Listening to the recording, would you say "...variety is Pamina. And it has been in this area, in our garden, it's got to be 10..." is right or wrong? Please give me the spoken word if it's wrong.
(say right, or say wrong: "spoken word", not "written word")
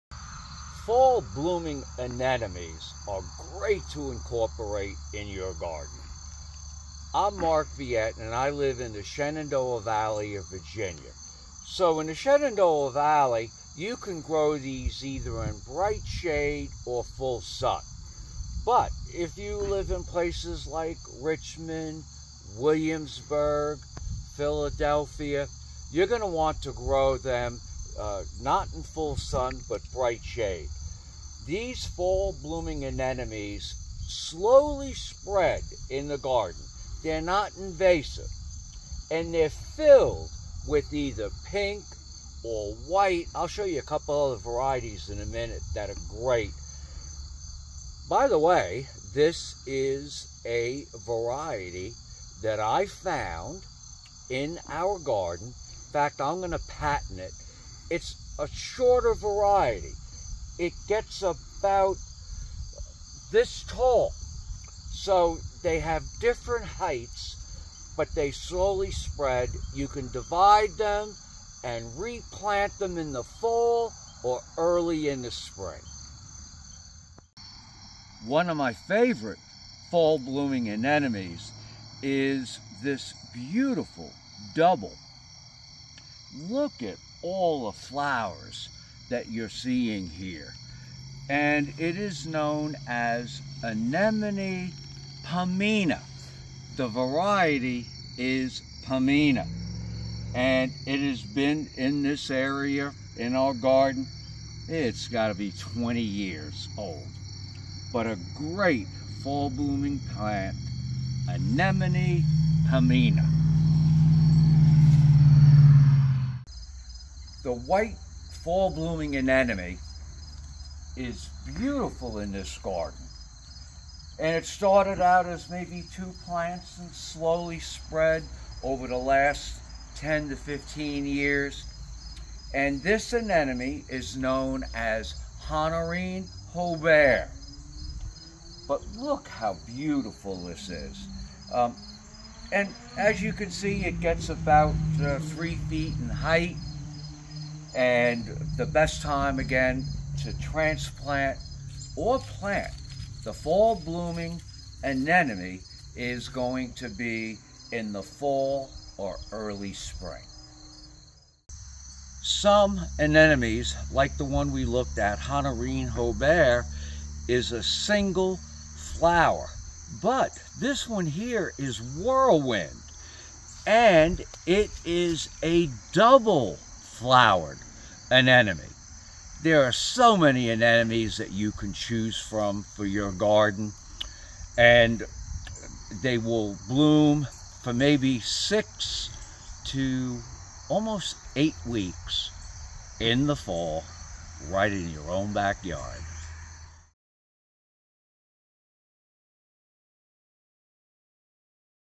wrong: "20", not "10".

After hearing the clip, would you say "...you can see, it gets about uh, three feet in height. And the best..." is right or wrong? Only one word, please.
right.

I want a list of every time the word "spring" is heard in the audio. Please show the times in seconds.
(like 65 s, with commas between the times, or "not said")
75 s, 159 s.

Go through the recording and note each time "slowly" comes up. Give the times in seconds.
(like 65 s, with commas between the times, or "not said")
34 s, 68 s, 126 s.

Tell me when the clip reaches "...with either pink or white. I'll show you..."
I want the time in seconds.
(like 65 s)
40 s.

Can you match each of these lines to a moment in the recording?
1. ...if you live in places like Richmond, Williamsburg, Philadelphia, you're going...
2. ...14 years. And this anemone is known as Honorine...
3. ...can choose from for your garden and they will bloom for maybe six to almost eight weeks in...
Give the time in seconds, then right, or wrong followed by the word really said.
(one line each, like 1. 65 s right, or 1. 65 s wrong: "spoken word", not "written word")
1. 19 s right
2. 130 s wrong: "15", not "14"
3. 181 s right.